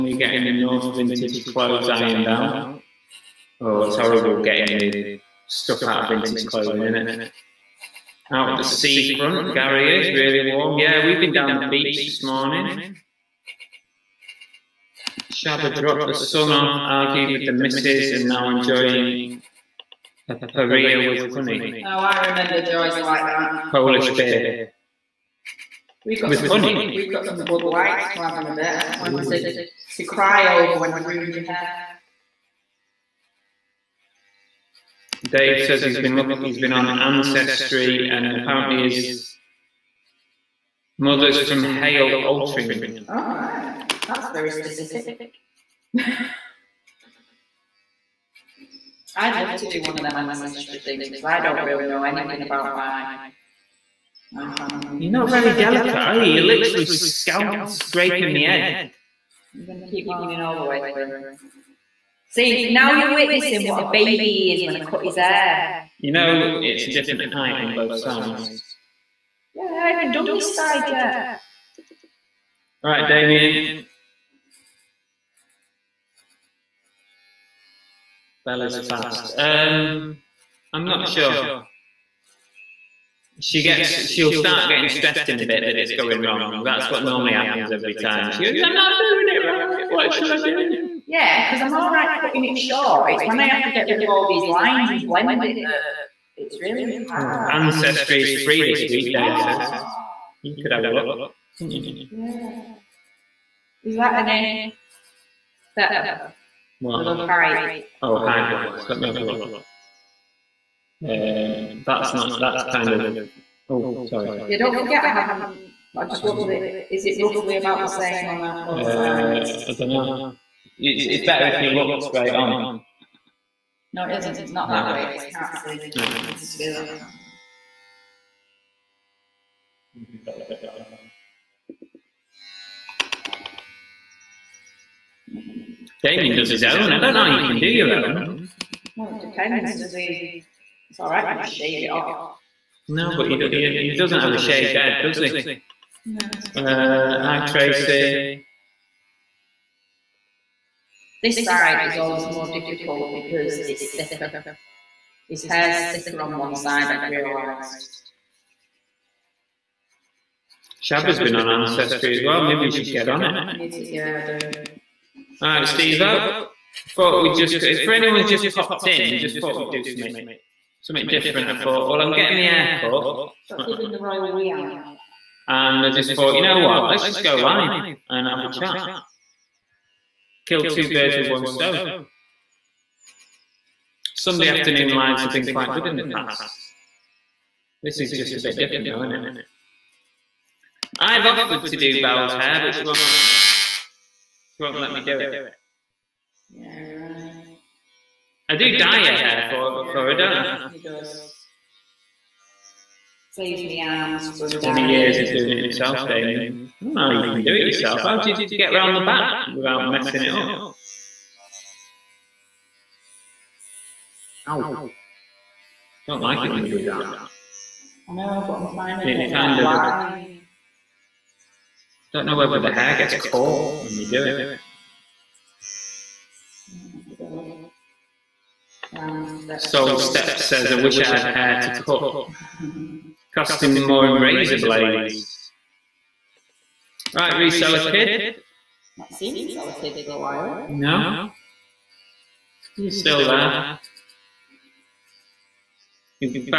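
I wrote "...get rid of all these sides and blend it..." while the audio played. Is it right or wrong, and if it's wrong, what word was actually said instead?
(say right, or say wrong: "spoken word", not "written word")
wrong: "lines", not "sides".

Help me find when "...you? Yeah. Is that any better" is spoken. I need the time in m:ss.
1:41.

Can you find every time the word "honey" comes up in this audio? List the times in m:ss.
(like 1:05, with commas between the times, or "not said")
0:21, 0:26.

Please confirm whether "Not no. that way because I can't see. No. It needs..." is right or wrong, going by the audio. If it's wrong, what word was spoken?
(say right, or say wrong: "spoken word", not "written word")
right.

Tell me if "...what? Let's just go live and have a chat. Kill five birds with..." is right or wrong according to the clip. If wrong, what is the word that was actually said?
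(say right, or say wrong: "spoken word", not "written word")
wrong: "two", not "five".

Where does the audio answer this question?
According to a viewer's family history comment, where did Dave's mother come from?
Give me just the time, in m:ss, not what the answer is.
0:41.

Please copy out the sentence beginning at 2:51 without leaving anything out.
I thought, well, I'm getting my hair cut.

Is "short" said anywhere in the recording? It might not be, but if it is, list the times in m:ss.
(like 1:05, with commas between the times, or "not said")
1:32.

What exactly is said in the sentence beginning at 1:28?
She goes, "I'm not doing it right.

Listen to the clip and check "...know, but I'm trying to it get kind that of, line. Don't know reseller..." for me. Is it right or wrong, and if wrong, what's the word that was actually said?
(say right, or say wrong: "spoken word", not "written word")
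wrong: "whether", not "reseller".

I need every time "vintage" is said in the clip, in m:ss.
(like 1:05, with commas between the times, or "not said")
0:00, 0:06.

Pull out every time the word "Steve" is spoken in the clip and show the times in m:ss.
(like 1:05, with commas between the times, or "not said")
2:45.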